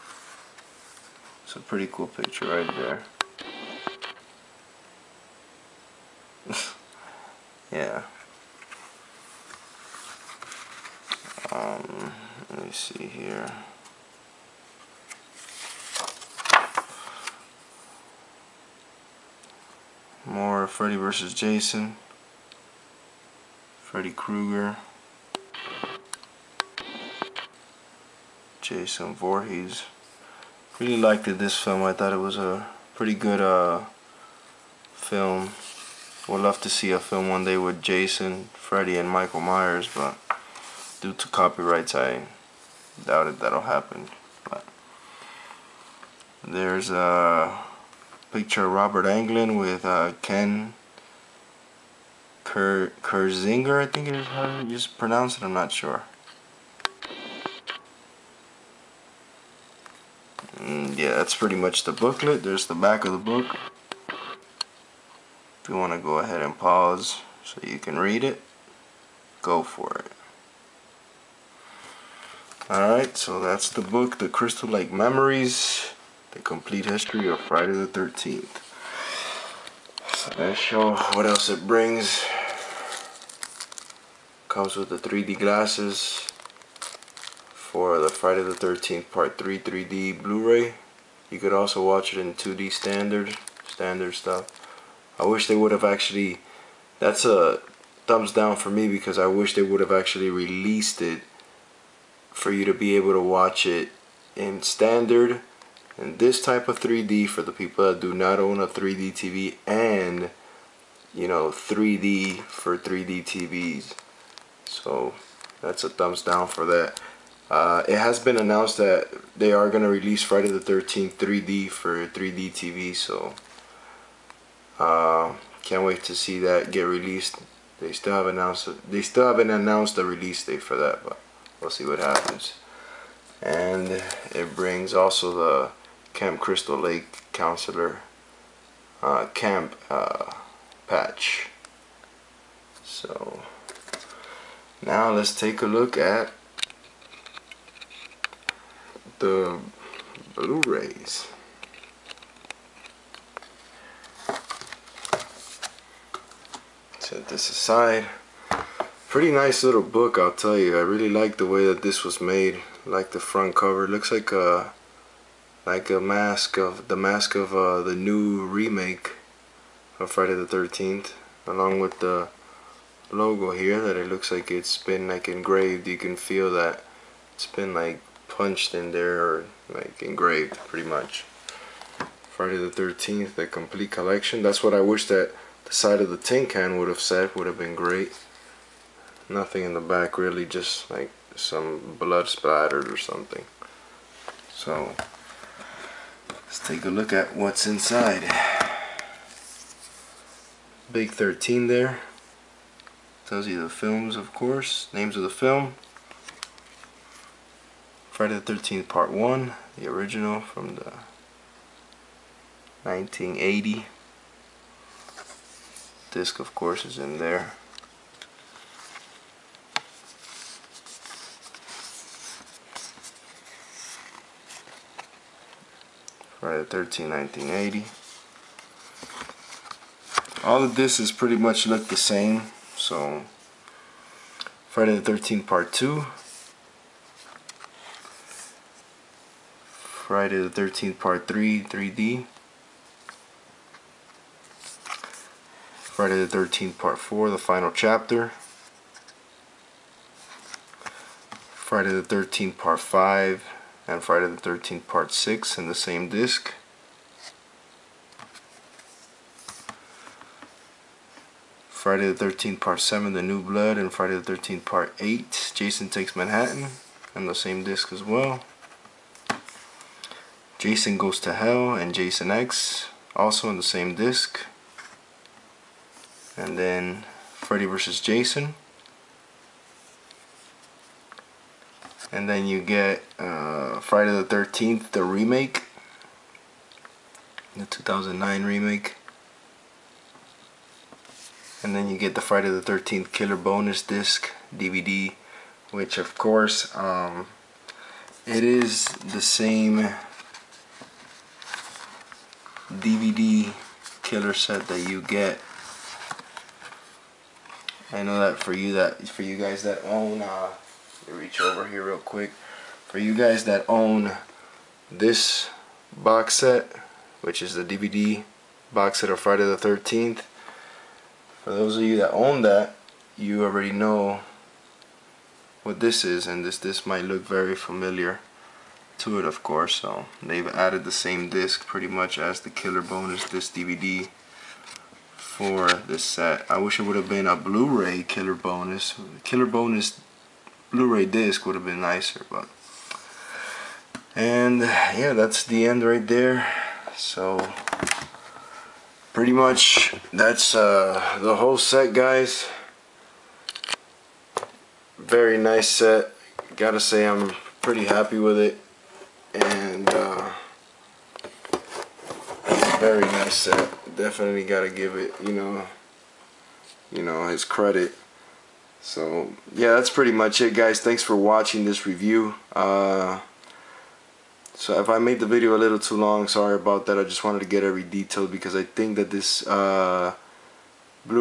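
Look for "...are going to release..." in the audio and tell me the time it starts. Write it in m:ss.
1:59.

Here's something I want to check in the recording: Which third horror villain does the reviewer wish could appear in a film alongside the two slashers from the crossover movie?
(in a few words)
Michael Myers.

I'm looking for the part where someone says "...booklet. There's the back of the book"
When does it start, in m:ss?
1:01.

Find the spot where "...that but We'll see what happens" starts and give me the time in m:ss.
2:10.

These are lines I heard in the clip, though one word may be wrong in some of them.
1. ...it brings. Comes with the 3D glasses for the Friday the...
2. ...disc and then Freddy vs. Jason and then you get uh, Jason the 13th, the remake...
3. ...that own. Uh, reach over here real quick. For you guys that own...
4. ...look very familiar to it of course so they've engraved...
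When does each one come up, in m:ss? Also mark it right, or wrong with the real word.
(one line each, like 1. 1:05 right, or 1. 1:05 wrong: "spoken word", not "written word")
1. 1:21 right
2. 4:33 wrong: "Friday", not "Jason"
3. 5:09 right
4. 5:27 wrong: "added", not "engraved".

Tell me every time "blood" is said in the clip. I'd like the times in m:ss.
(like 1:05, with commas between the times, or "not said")
3:11, 4:23.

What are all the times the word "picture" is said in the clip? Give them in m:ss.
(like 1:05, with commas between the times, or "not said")
0:02, 0:48.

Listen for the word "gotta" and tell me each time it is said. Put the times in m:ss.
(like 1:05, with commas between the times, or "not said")
5:56, 6:04.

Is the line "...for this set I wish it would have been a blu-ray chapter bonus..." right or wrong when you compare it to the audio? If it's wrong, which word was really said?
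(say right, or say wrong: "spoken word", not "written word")
wrong: "killer", not "chapter".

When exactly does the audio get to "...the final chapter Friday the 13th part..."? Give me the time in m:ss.
4:07.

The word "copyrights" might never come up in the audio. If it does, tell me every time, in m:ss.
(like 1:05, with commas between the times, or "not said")
0:41.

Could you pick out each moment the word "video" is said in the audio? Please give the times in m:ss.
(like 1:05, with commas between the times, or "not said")
6:15.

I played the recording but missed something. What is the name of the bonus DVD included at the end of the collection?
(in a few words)
Friday the 13th Killer Bonus Disc.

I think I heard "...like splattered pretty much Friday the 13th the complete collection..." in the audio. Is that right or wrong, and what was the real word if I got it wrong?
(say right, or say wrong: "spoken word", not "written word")
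wrong: "engraved", not "splattered".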